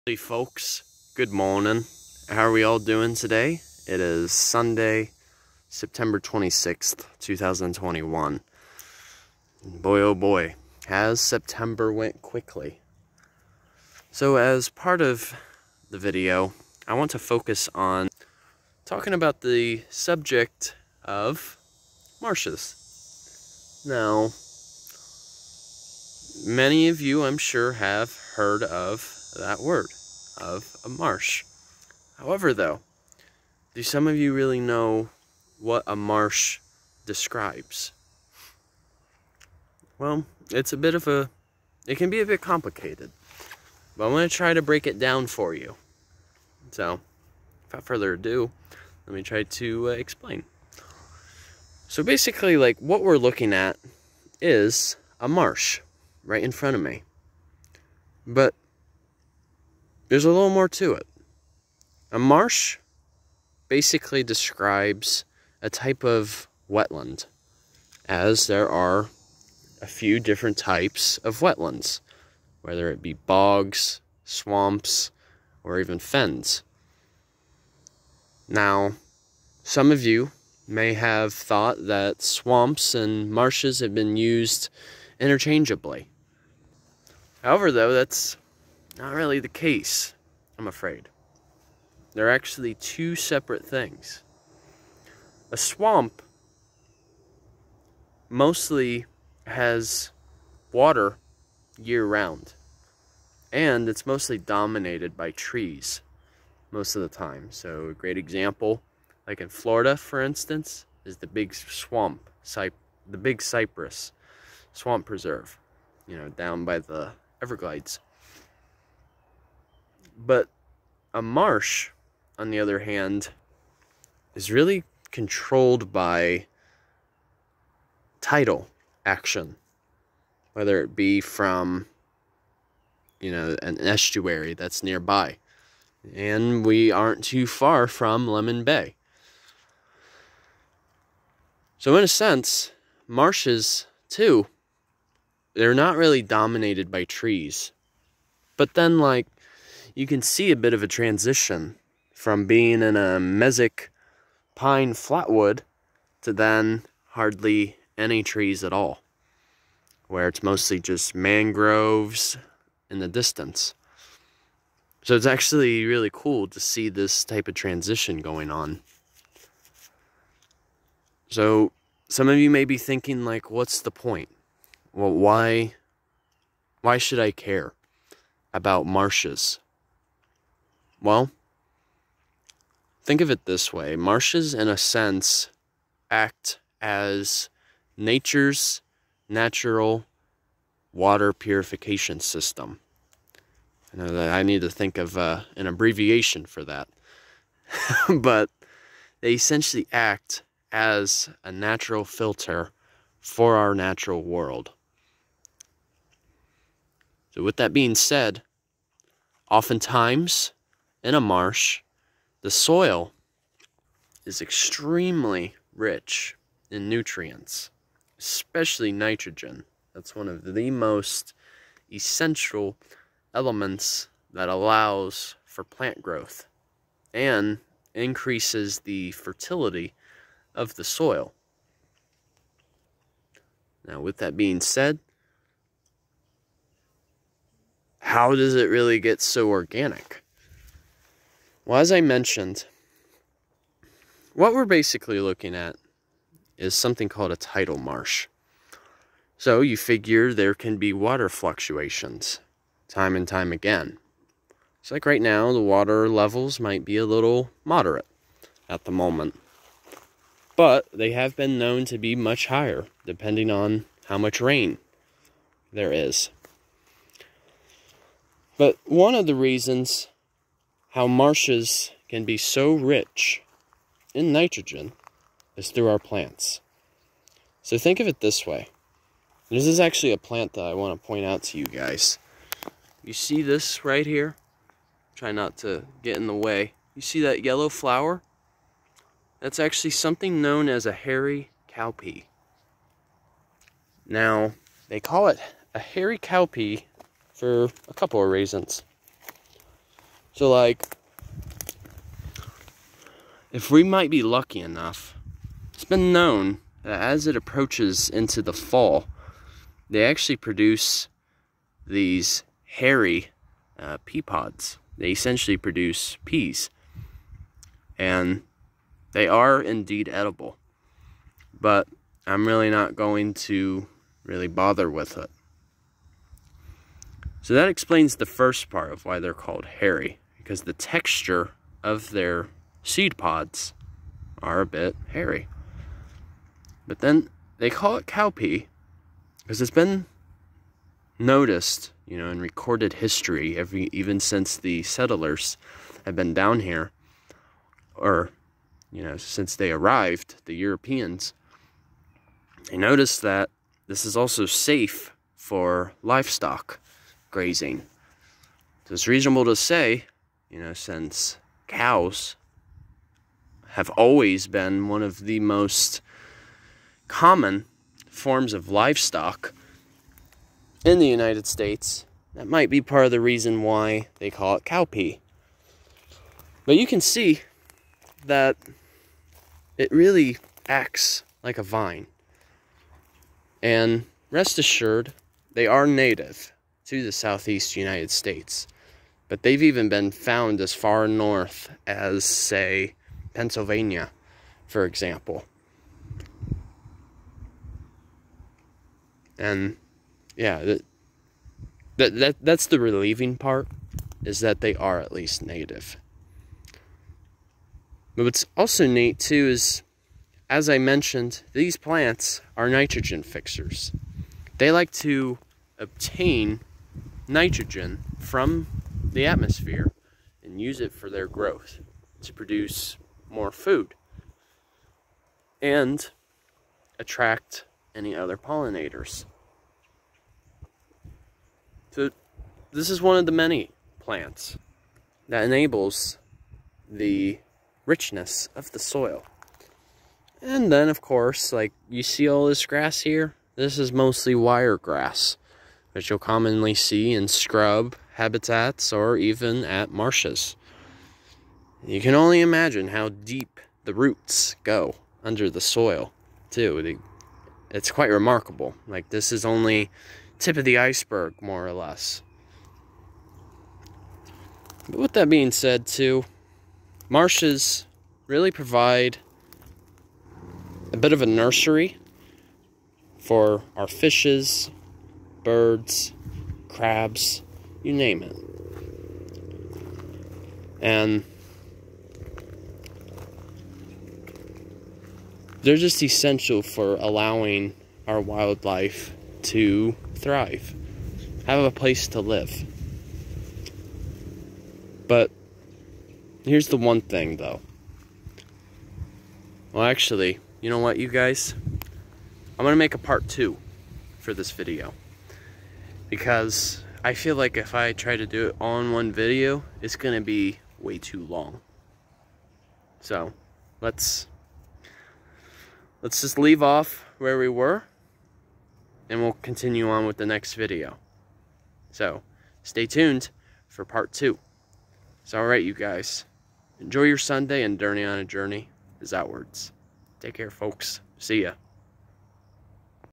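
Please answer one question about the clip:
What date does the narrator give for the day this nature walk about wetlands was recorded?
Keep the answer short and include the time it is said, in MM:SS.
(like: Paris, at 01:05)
September 26th, 2021, at 00:05.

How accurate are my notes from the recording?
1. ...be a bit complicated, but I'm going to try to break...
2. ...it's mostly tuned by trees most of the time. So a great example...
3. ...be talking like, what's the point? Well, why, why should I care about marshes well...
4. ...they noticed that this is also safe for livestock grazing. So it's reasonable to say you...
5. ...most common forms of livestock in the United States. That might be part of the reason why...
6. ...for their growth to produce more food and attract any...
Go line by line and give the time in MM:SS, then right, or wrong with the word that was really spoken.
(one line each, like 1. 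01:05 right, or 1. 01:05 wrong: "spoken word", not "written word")
1. 00:42 right
2. 01:43 wrong: "dominated", not "tuned"
3. 02:52 wrong: "thinking", not "talking"
4. 05:52 right
5. 06:05 right
6. 07:00 right.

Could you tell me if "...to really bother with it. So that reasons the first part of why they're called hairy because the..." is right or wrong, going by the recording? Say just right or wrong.
wrong.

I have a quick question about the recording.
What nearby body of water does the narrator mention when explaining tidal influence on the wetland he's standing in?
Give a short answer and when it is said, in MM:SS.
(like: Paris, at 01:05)
Lemon Bay, at 02:18.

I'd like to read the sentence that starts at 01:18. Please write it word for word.
Now, some of you may have thought that swamps and marshes have been used interchangeably.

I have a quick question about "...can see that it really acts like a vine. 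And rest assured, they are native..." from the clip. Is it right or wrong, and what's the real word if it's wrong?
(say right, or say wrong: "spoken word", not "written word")
right.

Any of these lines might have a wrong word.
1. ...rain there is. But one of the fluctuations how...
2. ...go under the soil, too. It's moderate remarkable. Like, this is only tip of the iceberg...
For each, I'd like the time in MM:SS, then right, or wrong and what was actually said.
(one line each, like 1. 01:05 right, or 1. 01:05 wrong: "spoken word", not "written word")
1. 04:24 wrong: "reasons", not "fluctuations"
2. 07:34 wrong: "quite", not "moderate".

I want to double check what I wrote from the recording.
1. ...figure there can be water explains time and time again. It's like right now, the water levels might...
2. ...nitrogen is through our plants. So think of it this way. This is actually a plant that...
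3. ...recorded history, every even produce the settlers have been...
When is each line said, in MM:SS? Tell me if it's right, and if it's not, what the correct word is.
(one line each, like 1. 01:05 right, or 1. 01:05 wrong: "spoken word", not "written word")
1. 04:09 wrong: "fluctuations", not "explains"
2. 04:34 right
3. 05:42 wrong: "since", not "produce".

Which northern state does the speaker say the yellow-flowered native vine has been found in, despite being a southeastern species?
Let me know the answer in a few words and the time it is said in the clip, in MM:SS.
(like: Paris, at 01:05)
Pennsylvania, at 06:33.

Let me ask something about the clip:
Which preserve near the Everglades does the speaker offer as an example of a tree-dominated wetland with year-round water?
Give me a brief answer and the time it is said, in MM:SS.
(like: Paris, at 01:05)
Big Cypress Swamp Preserve, at 01:53.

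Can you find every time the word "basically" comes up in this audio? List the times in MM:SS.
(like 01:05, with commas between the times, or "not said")
00:52, 01:03, 04:04.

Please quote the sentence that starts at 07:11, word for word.
So this is one of the many plants that enables the richness of the soil.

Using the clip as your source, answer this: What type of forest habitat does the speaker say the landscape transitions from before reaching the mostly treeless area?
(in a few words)
mesic pine flatwood.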